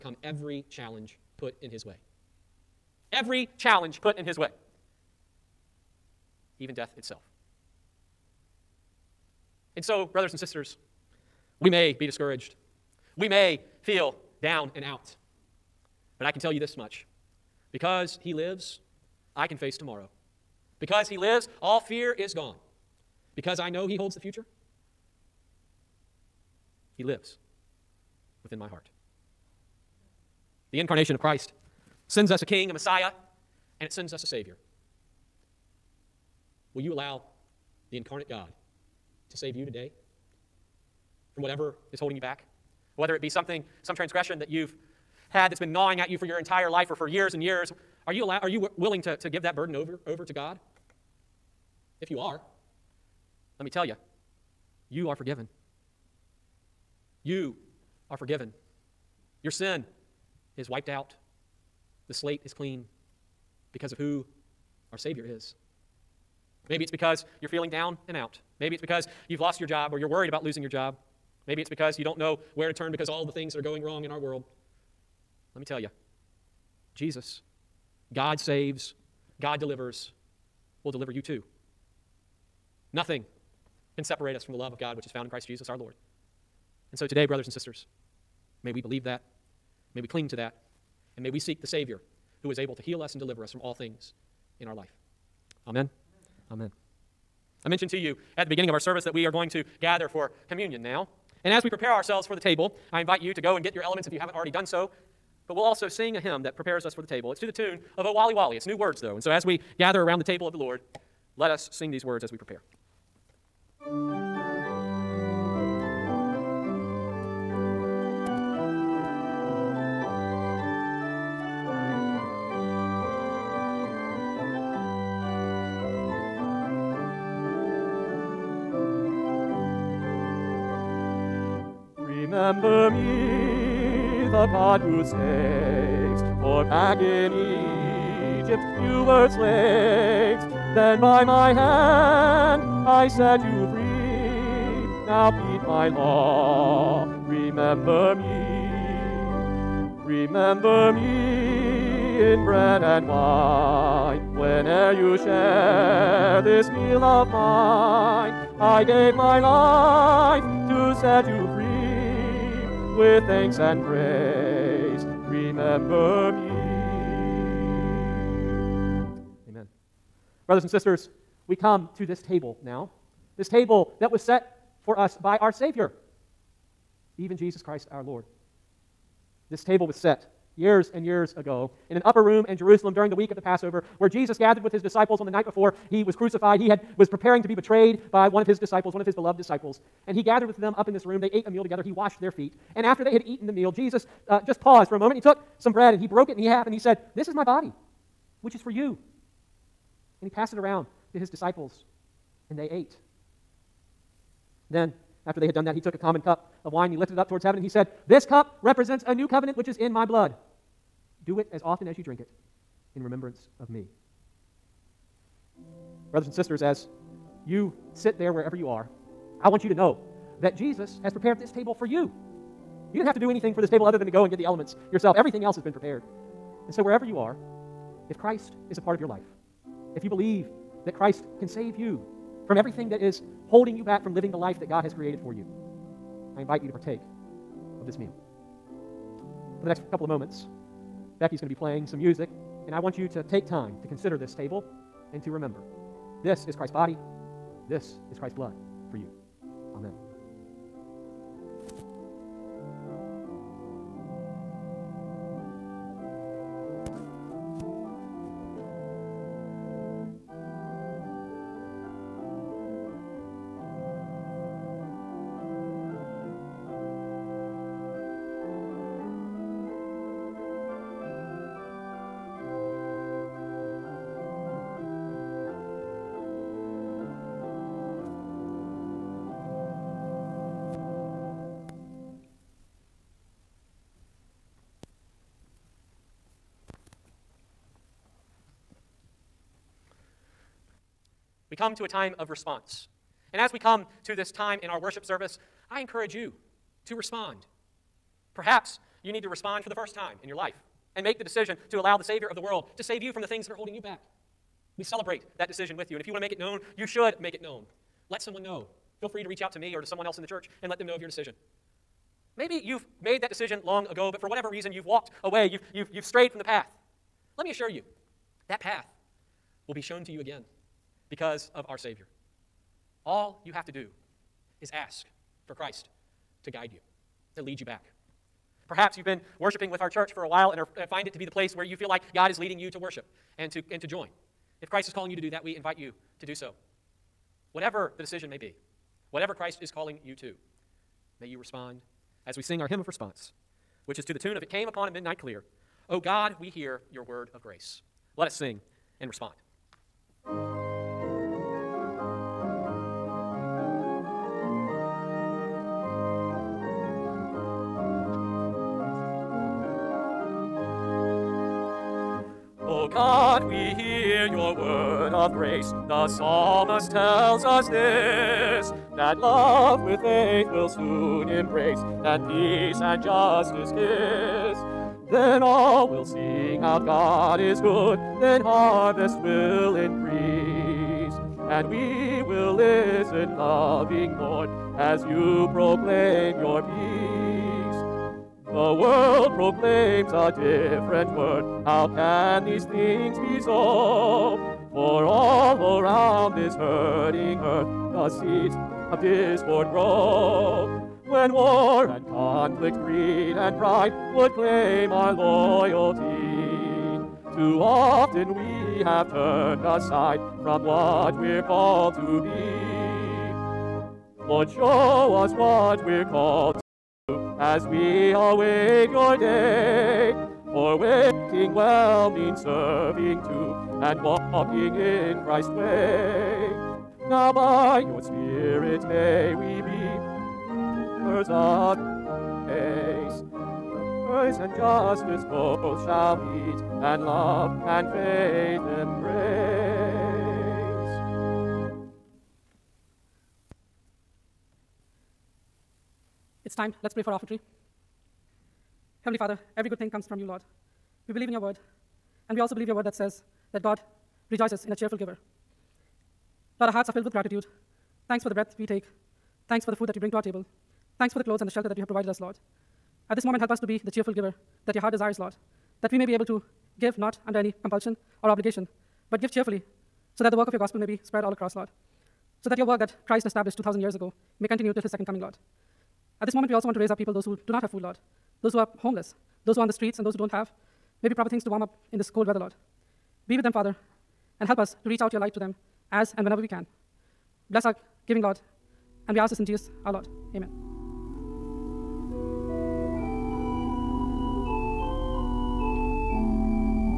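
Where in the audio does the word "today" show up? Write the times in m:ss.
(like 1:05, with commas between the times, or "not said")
0:39, 1:27.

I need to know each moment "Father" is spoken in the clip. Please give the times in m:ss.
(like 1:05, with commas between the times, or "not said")
7:29, 8:03.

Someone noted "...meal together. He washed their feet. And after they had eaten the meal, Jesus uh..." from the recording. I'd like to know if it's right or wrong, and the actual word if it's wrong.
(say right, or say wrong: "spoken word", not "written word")
right.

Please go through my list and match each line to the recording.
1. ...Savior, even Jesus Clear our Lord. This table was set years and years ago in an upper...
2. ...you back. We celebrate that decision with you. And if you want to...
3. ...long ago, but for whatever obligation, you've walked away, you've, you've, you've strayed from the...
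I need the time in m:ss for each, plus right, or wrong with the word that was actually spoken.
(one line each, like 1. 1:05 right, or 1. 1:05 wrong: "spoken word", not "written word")
1. 2:55 wrong: "Christ", not "Clear"
2. 5:03 right
3. 5:13 wrong: "reason", not "obligation".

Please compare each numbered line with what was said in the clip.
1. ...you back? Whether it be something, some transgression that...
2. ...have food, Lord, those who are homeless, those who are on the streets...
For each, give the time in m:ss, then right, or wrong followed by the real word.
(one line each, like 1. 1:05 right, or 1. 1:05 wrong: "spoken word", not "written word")
1. 0:42 right
2. 7:57 right.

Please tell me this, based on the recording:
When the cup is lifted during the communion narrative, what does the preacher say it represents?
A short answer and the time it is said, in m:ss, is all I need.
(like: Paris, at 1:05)
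A new covenant, at 3:29.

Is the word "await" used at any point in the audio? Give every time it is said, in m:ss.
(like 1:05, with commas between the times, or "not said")
6:58.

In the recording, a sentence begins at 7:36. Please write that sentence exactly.
Lord, our hearts are filled with gratitude.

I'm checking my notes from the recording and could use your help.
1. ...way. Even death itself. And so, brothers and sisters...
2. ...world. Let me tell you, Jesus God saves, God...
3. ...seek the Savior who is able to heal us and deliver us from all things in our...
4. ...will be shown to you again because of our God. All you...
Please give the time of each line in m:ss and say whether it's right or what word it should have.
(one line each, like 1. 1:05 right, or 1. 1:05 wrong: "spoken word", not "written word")
1. 0:04 right
2. 1:14 right
3. 1:31 right
4. 5:19 wrong: "Savior", not "God".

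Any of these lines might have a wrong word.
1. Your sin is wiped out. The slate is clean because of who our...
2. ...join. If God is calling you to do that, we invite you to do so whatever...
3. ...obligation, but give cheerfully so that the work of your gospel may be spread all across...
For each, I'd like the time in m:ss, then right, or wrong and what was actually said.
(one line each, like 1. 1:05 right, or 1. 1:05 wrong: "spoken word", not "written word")
1. 0:59 right
2. 5:33 wrong: "Christ", not "God"
3. 7:48 right.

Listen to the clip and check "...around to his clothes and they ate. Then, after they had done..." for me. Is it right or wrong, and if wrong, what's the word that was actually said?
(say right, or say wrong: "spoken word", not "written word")
wrong: "disciples", not "clothes".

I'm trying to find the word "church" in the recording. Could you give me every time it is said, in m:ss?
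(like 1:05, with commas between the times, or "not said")
5:10, 5:29.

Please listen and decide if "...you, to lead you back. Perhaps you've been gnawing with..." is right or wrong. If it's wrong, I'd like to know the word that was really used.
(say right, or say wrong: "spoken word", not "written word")
wrong: "worshiping", not "gnawing".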